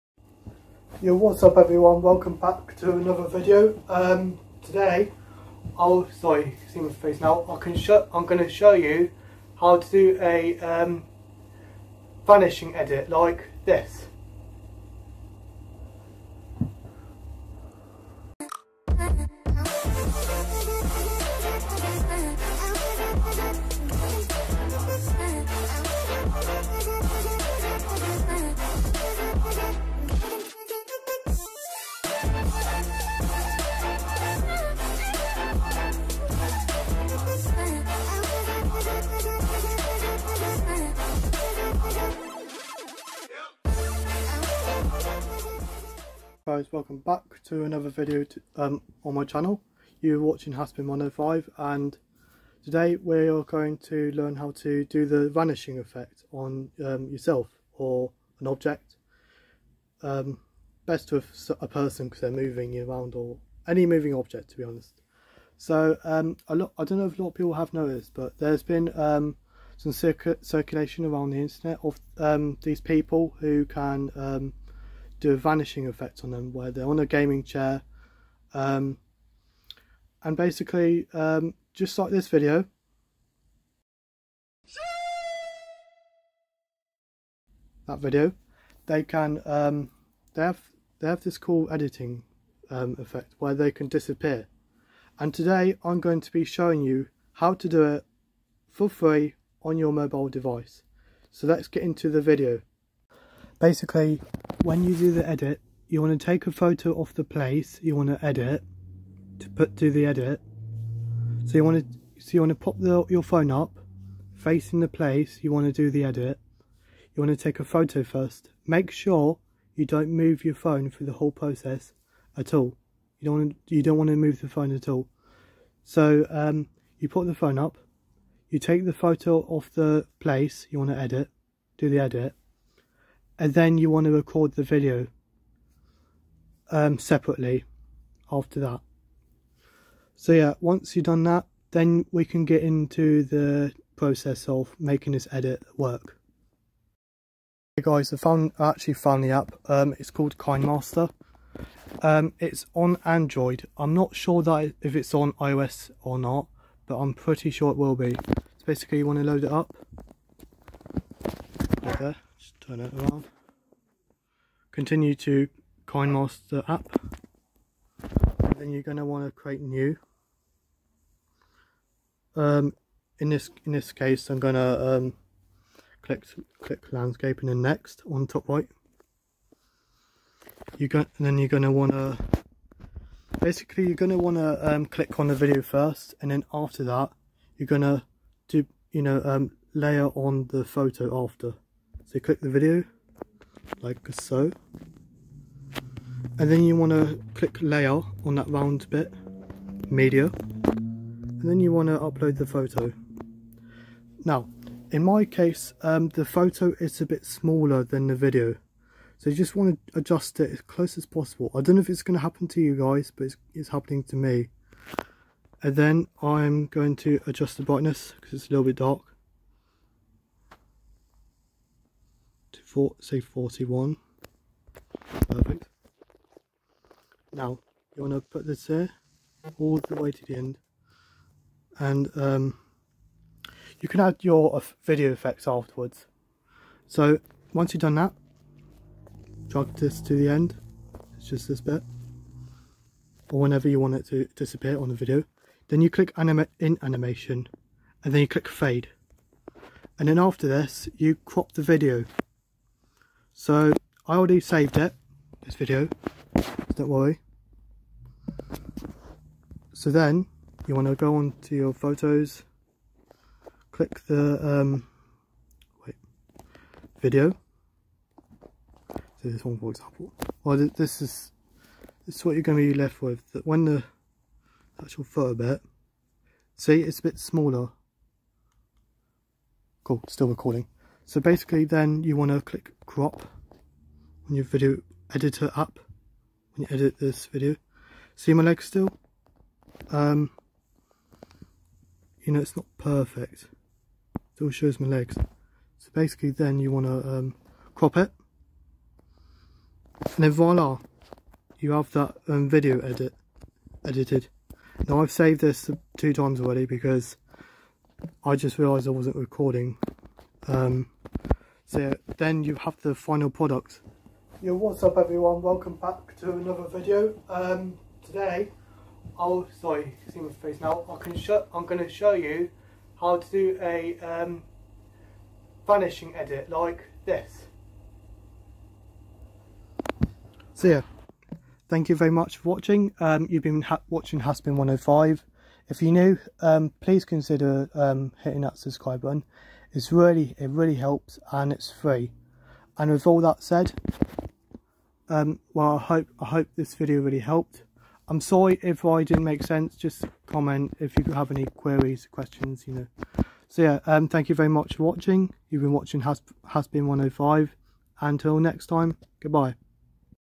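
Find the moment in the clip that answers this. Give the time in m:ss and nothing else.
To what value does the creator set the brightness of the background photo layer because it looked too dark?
3:42.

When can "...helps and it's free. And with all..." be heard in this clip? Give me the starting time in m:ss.
5:40.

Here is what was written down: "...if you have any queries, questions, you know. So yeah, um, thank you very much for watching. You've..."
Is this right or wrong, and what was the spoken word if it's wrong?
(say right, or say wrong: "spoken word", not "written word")
right.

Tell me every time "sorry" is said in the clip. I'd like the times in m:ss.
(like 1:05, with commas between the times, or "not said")
0:06, 5:19, 5:48.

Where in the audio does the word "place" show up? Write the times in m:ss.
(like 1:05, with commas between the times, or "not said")
1:47, 1:54, 2:10.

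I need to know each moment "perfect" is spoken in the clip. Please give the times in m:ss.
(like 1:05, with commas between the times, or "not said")
3:45, 4:52.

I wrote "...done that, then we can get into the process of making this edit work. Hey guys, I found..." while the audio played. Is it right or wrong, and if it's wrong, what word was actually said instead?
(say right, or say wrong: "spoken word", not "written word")
right.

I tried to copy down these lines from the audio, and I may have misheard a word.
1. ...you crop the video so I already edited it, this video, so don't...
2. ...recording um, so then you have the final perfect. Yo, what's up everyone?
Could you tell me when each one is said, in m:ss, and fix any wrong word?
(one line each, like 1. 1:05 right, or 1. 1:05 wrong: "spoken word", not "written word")
1. 4:10 wrong: "saved", not "edited"
2. 5:09 wrong: "product", not "perfect".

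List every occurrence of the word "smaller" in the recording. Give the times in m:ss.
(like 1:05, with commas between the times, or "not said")
3:27, 4:37.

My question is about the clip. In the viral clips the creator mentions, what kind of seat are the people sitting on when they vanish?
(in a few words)
Gaming chair.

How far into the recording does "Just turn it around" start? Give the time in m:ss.
2:42.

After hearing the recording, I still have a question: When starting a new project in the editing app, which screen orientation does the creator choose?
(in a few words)
Landscape.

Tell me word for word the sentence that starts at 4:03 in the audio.
Or whenever you want it to disappear on the video.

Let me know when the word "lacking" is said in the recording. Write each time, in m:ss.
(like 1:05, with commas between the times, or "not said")
not said.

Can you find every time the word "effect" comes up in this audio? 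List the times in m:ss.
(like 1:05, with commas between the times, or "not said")
0:55, 1:15, 1:32, 3:55.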